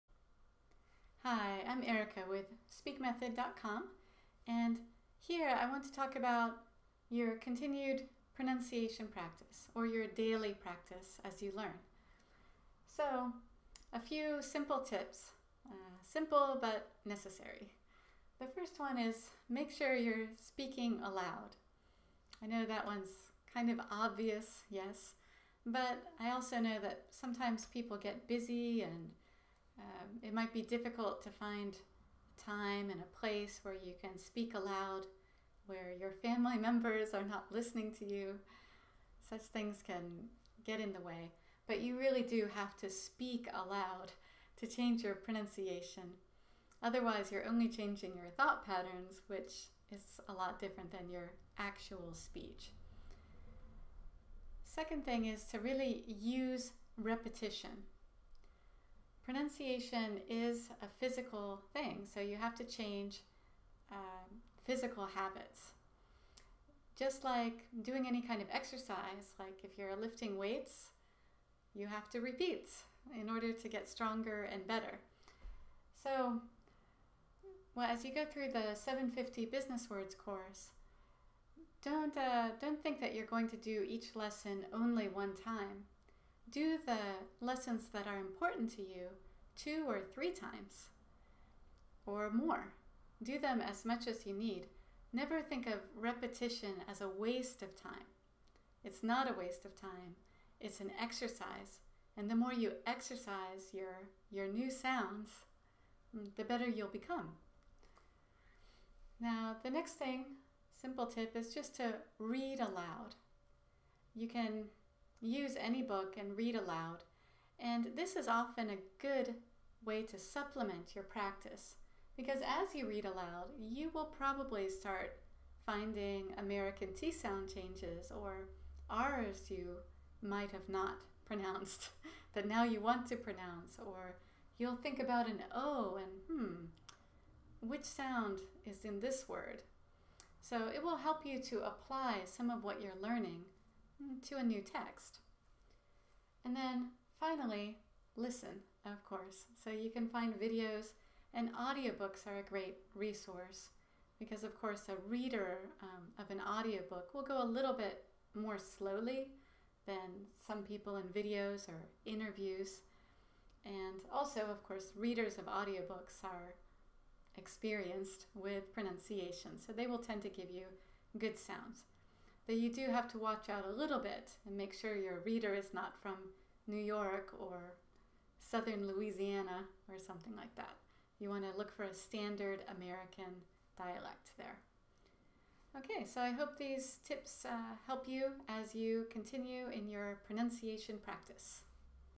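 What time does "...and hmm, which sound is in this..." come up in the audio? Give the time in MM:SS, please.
02:15.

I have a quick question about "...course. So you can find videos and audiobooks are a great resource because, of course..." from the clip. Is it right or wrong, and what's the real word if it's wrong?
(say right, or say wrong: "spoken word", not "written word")
right.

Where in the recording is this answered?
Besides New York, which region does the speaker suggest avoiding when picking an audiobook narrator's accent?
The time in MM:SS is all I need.
02:58.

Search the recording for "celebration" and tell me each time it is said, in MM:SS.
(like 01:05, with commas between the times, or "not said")
not said.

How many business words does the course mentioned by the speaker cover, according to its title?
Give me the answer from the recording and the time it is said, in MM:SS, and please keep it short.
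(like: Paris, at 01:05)
750, at 01:18.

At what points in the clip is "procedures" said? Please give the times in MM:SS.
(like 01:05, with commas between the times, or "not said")
not said.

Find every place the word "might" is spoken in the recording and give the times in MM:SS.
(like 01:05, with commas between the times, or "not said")
00:30, 02:10.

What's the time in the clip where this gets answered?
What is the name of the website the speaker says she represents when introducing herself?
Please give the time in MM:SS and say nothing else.
00:02.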